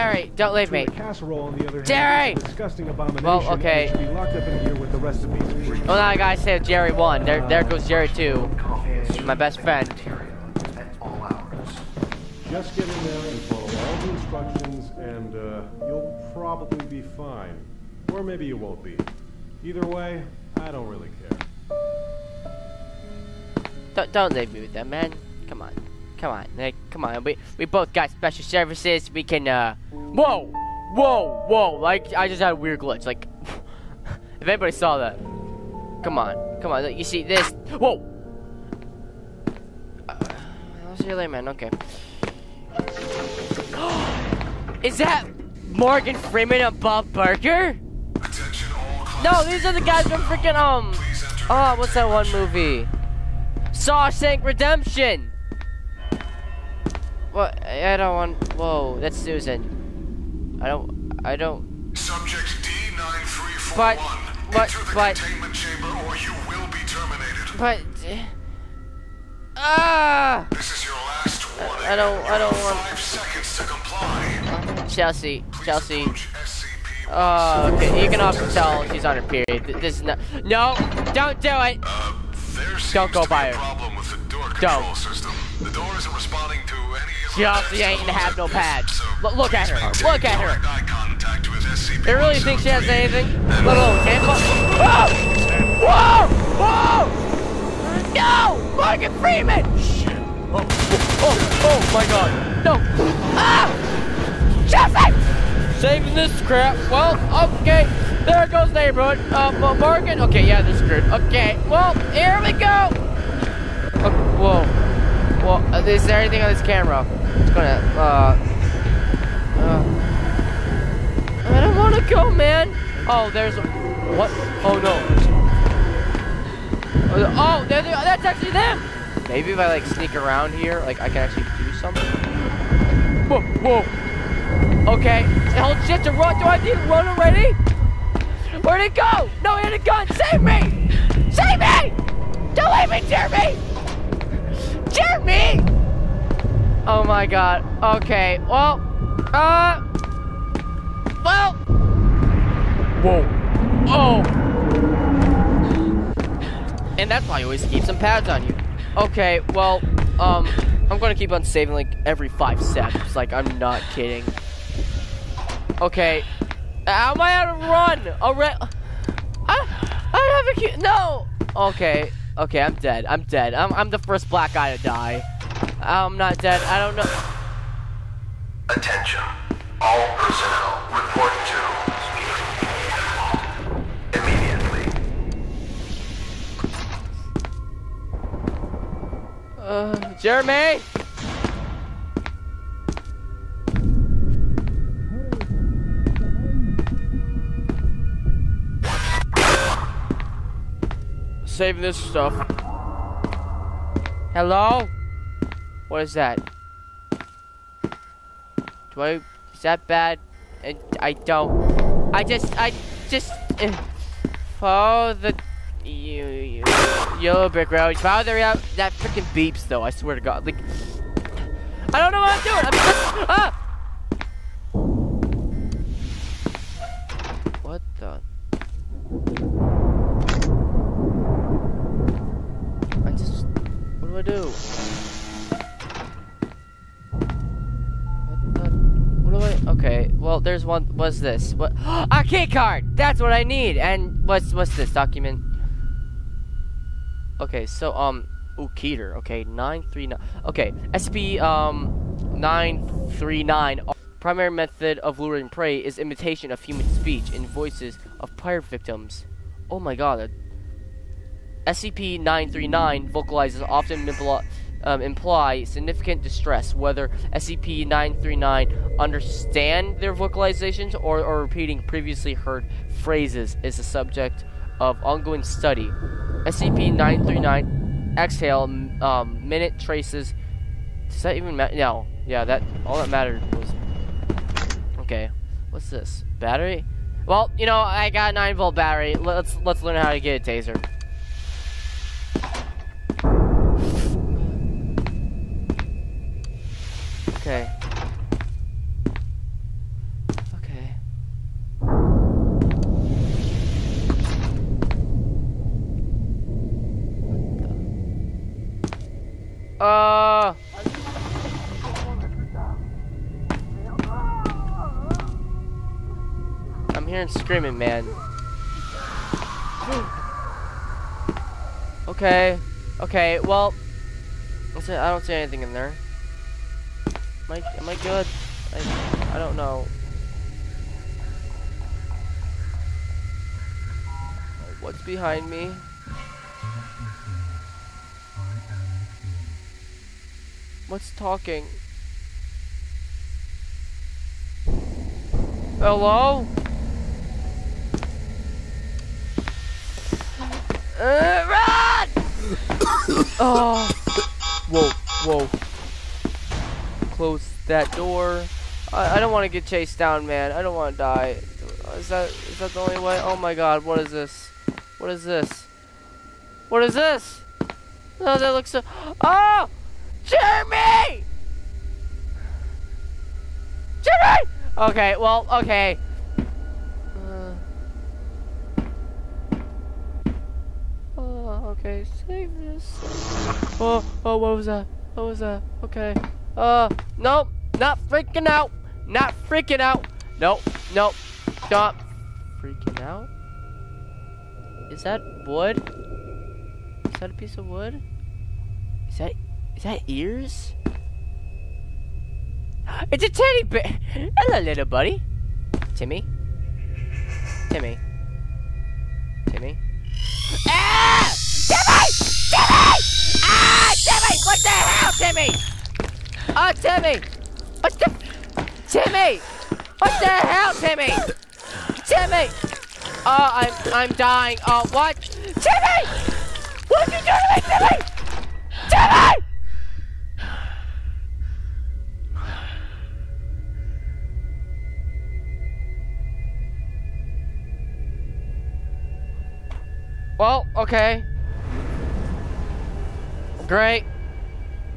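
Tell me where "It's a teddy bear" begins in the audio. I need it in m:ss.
6:43.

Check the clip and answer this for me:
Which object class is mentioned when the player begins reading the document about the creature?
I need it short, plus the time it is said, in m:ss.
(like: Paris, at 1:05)
Keter, at 4:08.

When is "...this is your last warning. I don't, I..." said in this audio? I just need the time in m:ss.
1:10.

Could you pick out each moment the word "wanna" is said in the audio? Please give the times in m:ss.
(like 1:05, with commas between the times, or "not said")
2:01.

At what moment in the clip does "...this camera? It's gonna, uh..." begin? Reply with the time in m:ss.
1:56.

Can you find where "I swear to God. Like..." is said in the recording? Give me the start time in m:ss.
3:39.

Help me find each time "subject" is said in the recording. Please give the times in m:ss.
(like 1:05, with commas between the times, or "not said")
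1:01, 4:33.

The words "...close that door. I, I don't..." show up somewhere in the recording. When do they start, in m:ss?
5:57.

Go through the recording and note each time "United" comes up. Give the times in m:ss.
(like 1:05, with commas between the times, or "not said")
not said.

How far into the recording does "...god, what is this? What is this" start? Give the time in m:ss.
6:03.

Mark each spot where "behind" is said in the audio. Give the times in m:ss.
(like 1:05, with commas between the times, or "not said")
5:35.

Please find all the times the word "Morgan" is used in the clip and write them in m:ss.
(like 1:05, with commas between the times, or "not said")
0:45, 1:38, 1:49.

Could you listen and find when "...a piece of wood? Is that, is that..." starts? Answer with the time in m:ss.
6:37.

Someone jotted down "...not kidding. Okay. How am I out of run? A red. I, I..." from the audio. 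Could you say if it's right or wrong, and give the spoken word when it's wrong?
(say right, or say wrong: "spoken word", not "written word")
right.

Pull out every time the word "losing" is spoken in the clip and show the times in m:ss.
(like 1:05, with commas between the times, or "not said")
not said.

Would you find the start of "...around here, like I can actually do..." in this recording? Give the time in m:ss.
2:10.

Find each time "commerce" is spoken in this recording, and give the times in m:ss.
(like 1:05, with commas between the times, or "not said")
not said.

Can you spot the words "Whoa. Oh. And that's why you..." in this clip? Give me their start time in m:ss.
2:33.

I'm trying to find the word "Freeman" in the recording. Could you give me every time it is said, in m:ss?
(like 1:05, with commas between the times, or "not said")
0:46, 1:39.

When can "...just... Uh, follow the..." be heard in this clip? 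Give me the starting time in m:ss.
3:33.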